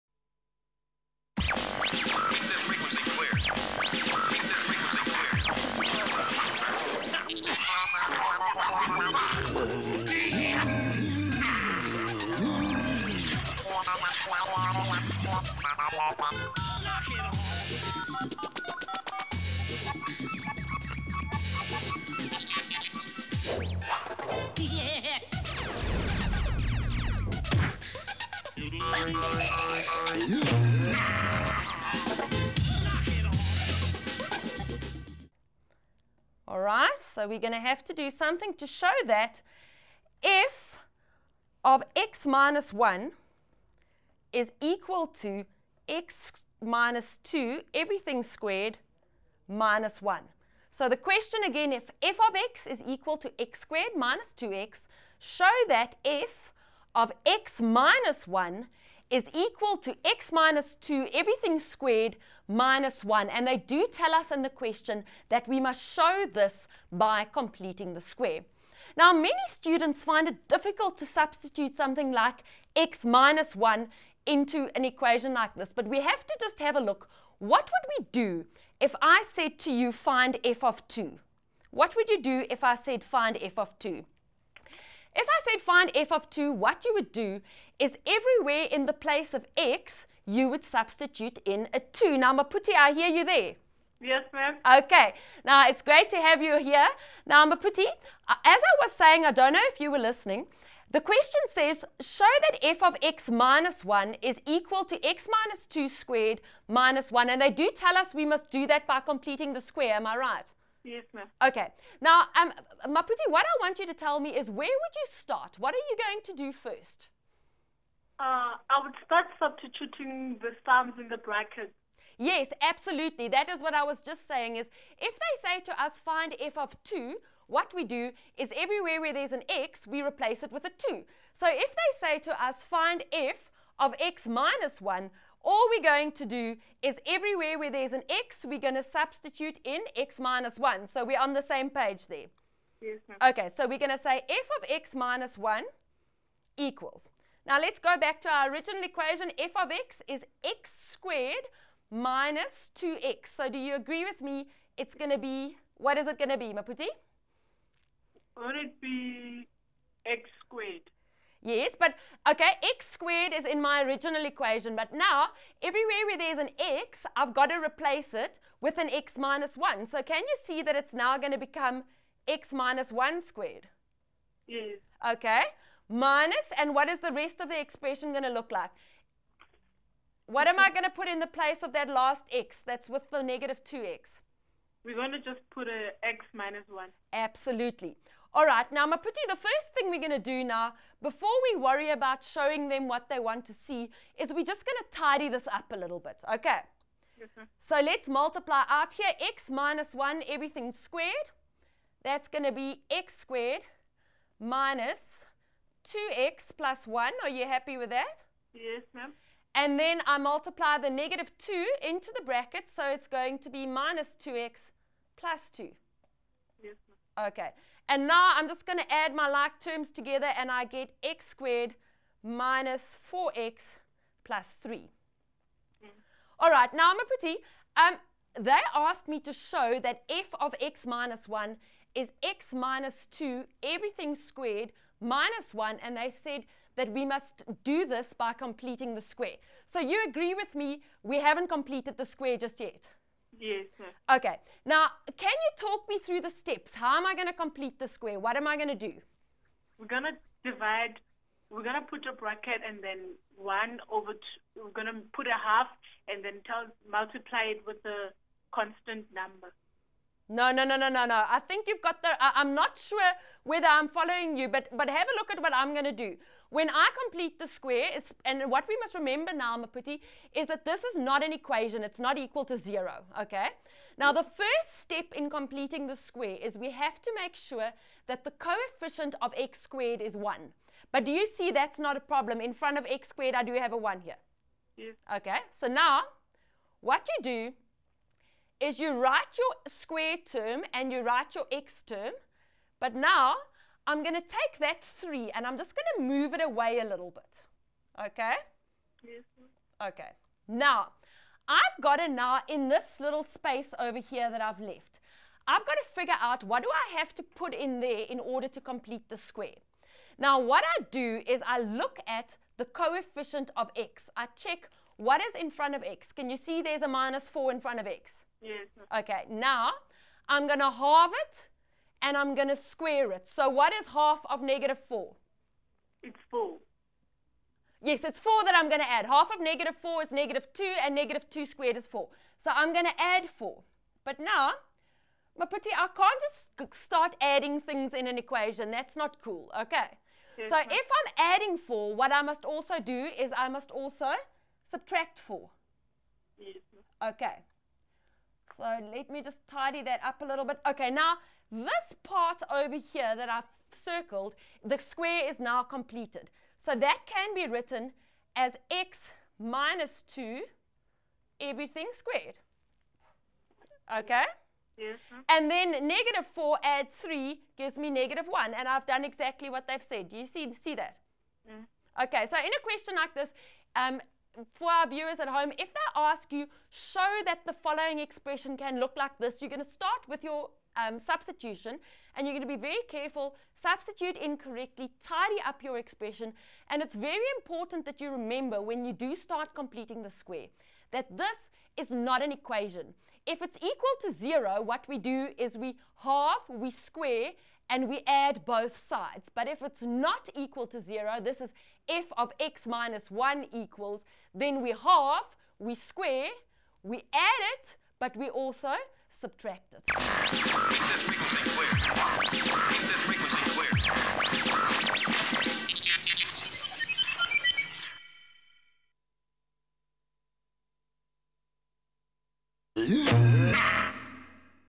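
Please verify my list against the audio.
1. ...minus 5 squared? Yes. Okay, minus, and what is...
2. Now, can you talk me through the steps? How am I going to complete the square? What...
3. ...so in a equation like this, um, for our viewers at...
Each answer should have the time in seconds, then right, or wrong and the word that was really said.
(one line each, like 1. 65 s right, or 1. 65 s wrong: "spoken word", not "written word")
1. 172 s wrong: "1", not "5"
2. 244 s right
3. 372 s wrong: "question", not "equation".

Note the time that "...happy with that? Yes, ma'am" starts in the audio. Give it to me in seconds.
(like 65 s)
207 s.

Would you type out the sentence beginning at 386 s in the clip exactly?
And it's very important that you remember when you do start completing the square that this is not an equation.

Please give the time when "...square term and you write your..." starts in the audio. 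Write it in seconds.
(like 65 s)
289 s.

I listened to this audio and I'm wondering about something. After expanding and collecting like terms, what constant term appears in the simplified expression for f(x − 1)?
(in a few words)
3.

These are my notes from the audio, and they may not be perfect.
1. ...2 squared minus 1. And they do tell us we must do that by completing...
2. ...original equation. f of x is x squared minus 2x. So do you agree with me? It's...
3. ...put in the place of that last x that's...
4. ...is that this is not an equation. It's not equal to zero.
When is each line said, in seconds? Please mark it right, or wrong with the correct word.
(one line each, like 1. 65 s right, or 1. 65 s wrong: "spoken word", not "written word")
1. 105 s right
2. 148 s right
3. 180 s right
4. 270 s right.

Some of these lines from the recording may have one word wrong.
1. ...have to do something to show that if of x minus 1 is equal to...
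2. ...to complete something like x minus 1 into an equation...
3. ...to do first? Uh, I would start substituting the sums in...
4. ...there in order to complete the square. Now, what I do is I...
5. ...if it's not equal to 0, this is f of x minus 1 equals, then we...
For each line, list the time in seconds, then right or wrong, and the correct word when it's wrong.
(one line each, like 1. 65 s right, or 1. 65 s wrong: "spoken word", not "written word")
1. 37 s right
2. 70 s wrong: "substitute", not "complete"
3. 116 s right
4. 307 s right
5. 399 s right.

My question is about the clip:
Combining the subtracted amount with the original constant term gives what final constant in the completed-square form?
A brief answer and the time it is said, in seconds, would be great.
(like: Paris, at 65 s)
-1, at 367 s.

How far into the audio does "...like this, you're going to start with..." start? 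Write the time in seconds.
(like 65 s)
378 s.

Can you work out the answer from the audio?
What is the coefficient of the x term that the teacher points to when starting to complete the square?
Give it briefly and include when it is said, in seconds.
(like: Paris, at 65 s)
-4, at 316 s.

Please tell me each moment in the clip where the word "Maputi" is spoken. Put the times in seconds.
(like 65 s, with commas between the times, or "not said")
92 s, 97 s, 112 s, 156 s, 188 s, 269 s, 335 s.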